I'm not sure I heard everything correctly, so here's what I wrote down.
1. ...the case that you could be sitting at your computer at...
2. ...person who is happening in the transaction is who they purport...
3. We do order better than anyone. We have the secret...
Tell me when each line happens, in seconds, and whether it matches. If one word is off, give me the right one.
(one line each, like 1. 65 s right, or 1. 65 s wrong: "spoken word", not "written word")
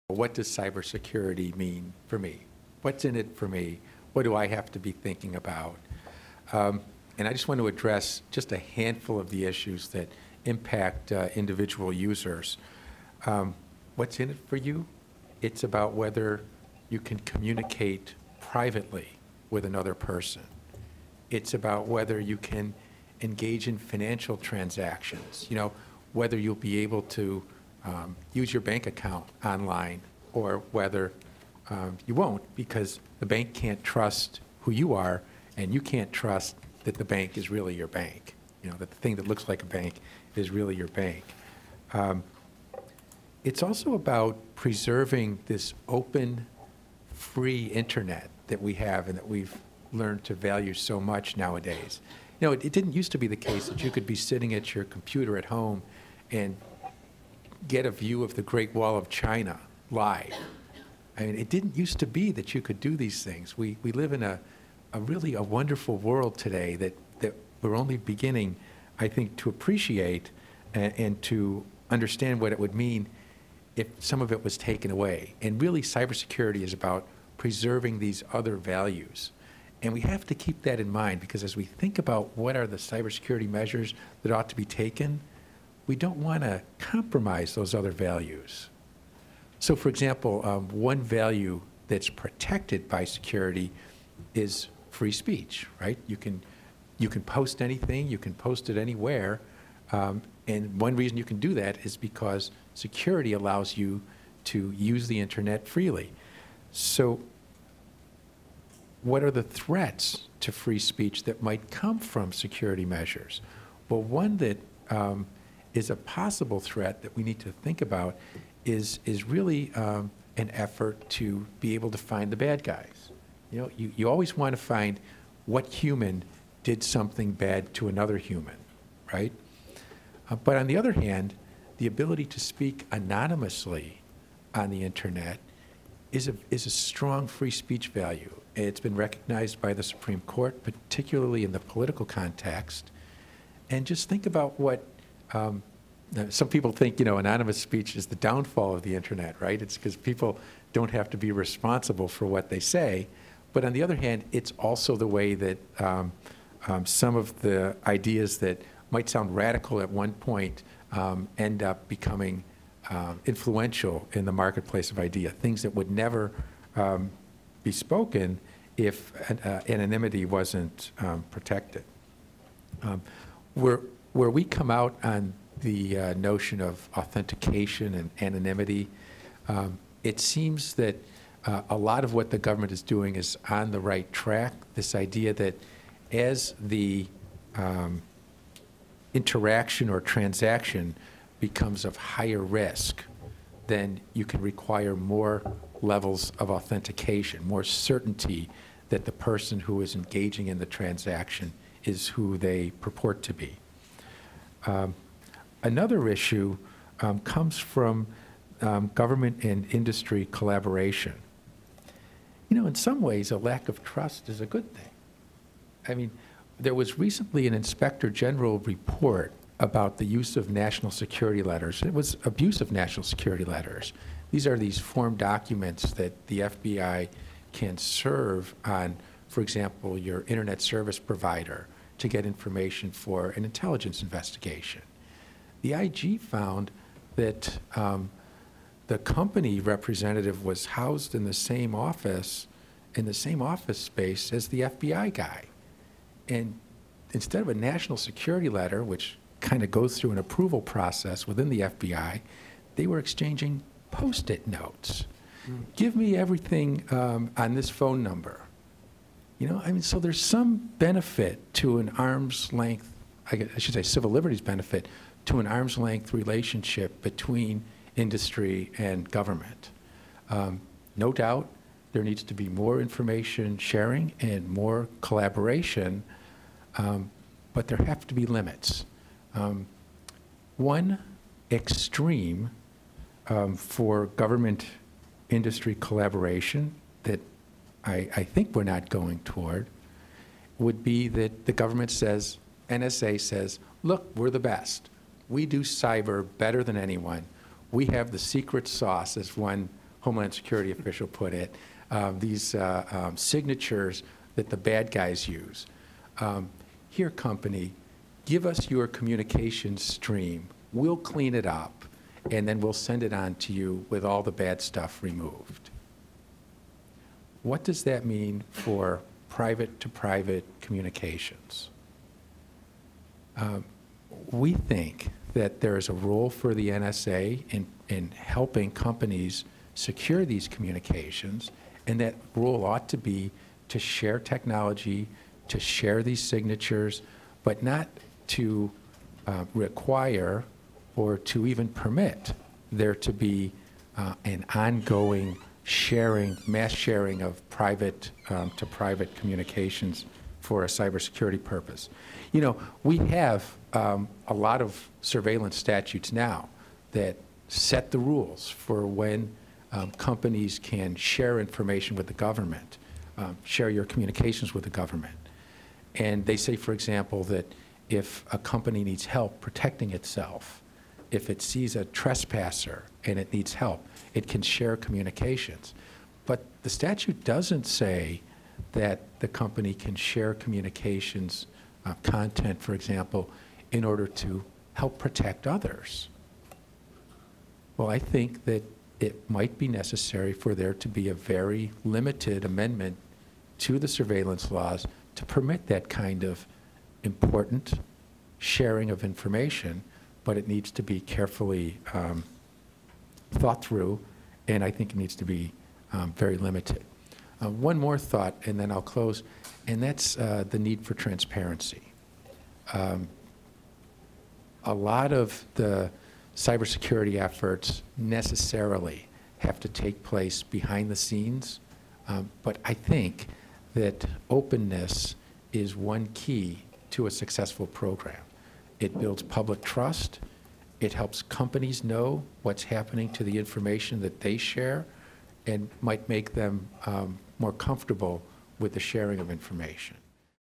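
1. 53 s right
2. 199 s wrong: "engaging", not "happening"
3. 295 s wrong: "cyber", not "order".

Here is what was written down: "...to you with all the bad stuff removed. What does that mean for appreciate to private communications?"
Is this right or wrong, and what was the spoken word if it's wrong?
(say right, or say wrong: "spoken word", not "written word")
wrong: "private", not "appreciate".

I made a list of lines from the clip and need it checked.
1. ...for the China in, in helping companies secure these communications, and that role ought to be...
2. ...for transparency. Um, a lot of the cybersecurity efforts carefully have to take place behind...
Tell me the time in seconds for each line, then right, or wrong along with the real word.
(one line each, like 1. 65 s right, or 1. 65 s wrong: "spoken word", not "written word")
1. 326 s wrong: "NSA", not "China"
2. 410 s wrong: "necessarily", not "carefully".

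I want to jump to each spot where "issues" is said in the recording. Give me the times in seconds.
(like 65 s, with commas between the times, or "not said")
9 s, 206 s.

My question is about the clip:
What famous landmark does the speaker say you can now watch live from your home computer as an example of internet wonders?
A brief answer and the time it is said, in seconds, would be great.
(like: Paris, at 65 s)
Great Wall of China, at 58 s.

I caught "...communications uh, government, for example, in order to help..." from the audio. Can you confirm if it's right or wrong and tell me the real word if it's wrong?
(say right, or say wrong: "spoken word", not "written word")
wrong: "content", not "government".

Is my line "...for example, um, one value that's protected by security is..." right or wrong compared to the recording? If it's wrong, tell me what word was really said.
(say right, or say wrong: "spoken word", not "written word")
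right.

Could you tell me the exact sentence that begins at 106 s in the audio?
So, what are the threats to free speech that might come from security measures?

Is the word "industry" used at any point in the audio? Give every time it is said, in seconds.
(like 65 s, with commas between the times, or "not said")
209 s, 267 s, 285 s.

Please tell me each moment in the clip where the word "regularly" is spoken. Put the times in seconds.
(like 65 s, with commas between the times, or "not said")
not said.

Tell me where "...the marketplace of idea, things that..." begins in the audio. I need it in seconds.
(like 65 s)
164 s.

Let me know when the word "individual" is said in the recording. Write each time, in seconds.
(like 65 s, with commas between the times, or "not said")
11 s.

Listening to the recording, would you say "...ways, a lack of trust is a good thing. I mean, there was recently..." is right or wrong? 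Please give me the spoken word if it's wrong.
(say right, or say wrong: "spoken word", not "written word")
right.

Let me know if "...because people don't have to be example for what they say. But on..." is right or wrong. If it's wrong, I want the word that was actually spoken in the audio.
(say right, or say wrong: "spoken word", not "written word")
wrong: "responsible", not "example".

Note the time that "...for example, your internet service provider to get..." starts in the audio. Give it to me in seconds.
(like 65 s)
229 s.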